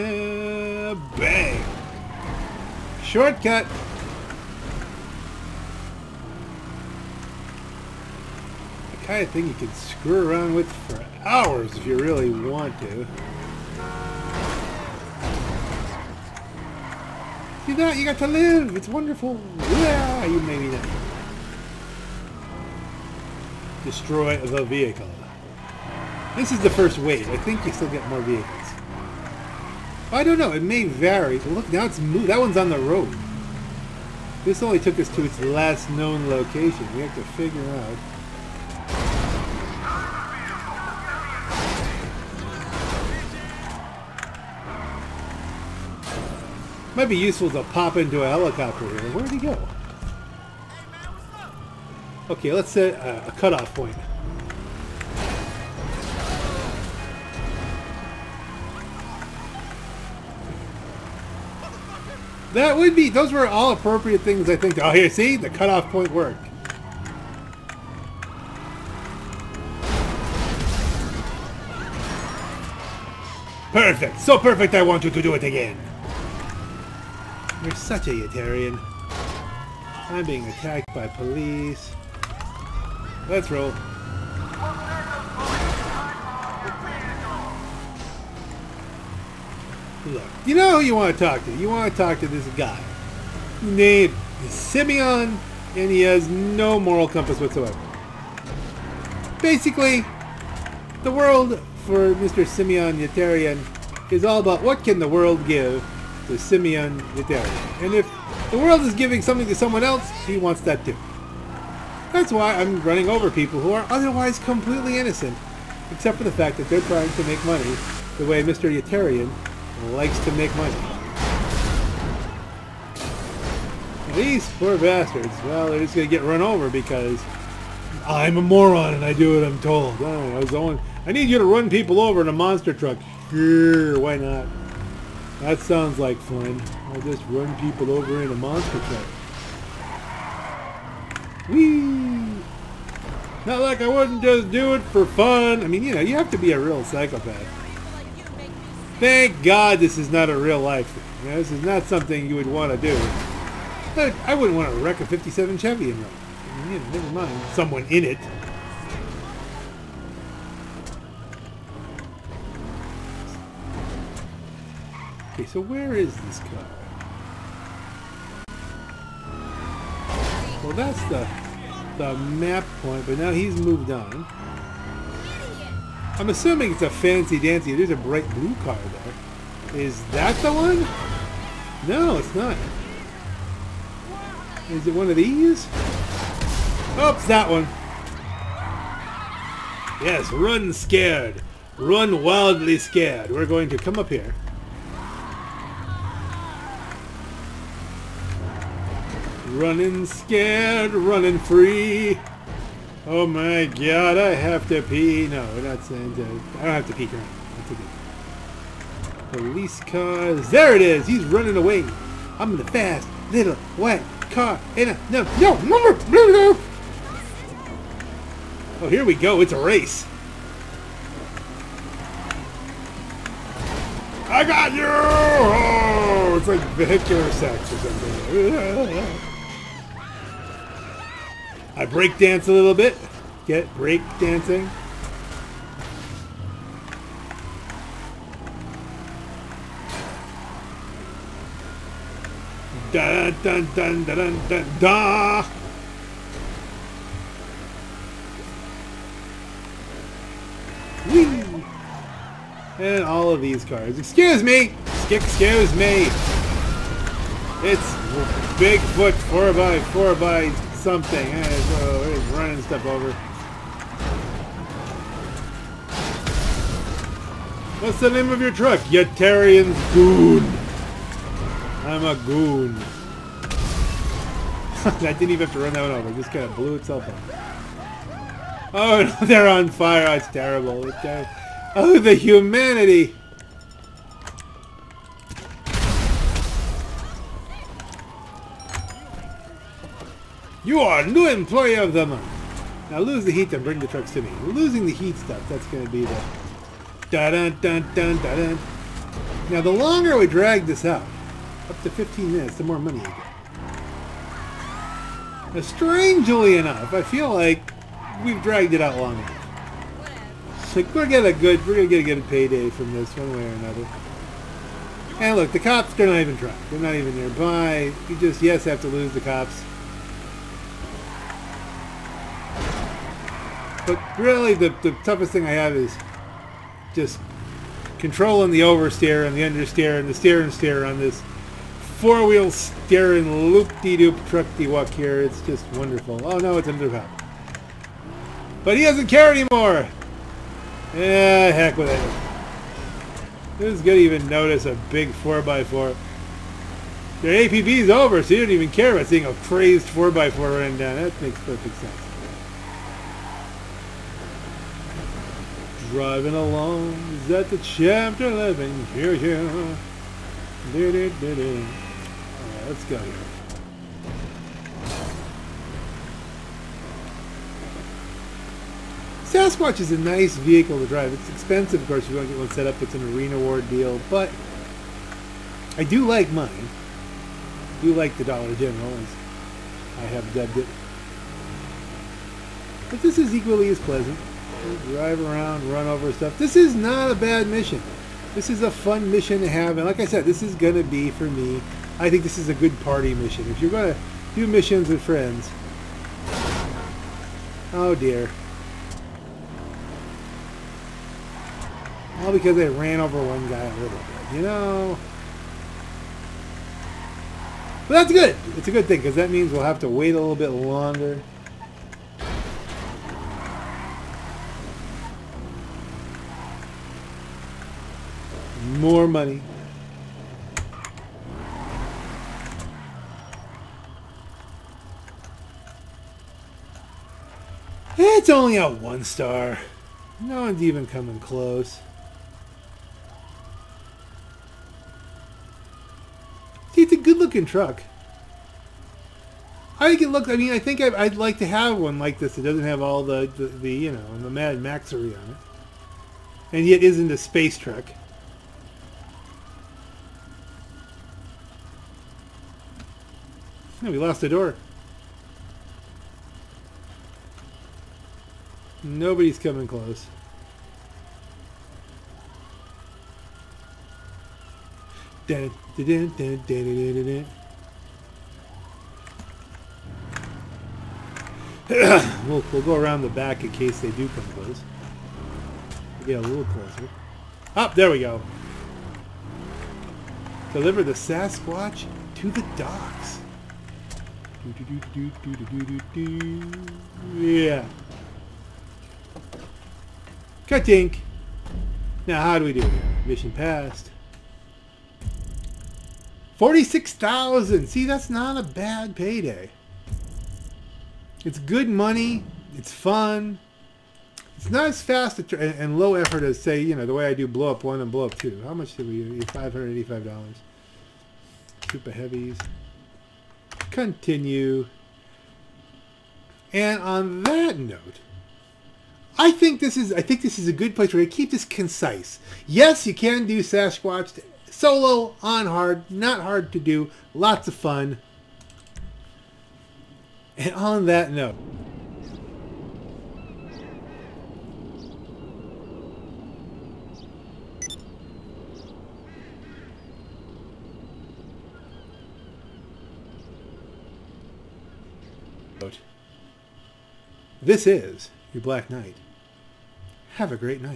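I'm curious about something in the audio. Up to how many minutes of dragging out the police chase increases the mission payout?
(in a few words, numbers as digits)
15.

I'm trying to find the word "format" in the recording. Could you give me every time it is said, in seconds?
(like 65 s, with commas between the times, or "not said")
not said.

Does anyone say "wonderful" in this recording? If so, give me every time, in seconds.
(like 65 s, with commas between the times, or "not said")
18 s, 335 s.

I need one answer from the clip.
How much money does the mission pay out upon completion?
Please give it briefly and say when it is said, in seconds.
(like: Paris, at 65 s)
46,000, at 496 s.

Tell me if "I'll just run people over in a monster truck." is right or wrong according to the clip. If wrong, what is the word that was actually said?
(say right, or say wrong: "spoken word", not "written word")
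right.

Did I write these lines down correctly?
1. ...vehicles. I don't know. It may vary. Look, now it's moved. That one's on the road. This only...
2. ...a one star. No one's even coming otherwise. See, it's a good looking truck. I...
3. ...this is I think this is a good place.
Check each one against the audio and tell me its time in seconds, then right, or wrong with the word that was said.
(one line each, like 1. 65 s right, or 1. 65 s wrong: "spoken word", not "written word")
1. 28 s right
2. 428 s wrong: "close", not "otherwise"
3. 519 s right.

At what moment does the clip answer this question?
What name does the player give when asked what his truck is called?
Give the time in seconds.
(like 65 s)
268 s.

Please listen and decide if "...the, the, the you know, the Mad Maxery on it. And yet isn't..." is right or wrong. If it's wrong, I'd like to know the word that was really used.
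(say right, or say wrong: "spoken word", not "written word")
right.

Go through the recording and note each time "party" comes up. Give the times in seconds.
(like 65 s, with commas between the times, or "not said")
392 s.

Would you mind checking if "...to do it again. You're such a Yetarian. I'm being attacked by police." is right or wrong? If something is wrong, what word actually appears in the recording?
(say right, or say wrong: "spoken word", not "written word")
right.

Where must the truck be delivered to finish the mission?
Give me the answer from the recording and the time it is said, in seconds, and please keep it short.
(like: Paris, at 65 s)
the docks, at 482 s.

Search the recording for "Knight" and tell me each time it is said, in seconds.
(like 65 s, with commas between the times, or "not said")
548 s.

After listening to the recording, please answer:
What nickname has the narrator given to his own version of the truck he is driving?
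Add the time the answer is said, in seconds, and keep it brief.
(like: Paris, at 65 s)
Dollar General, at 378 s.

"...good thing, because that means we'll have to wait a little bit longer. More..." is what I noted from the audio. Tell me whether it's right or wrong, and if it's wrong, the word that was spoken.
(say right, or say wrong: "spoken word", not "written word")
right.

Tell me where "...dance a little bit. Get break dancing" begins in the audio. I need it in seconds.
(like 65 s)
232 s.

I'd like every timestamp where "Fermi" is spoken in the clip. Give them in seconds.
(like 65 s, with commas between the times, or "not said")
not said.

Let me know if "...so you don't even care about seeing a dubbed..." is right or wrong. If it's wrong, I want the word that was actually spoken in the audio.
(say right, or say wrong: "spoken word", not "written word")
wrong: "crazed", not "dubbed".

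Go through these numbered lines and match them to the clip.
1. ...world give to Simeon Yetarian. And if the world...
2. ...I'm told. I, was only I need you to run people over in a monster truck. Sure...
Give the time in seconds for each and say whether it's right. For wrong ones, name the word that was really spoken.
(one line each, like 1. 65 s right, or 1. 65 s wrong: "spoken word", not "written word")
1. 105 s right
2. 129 s right.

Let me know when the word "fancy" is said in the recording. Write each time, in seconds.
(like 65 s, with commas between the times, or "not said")
176 s.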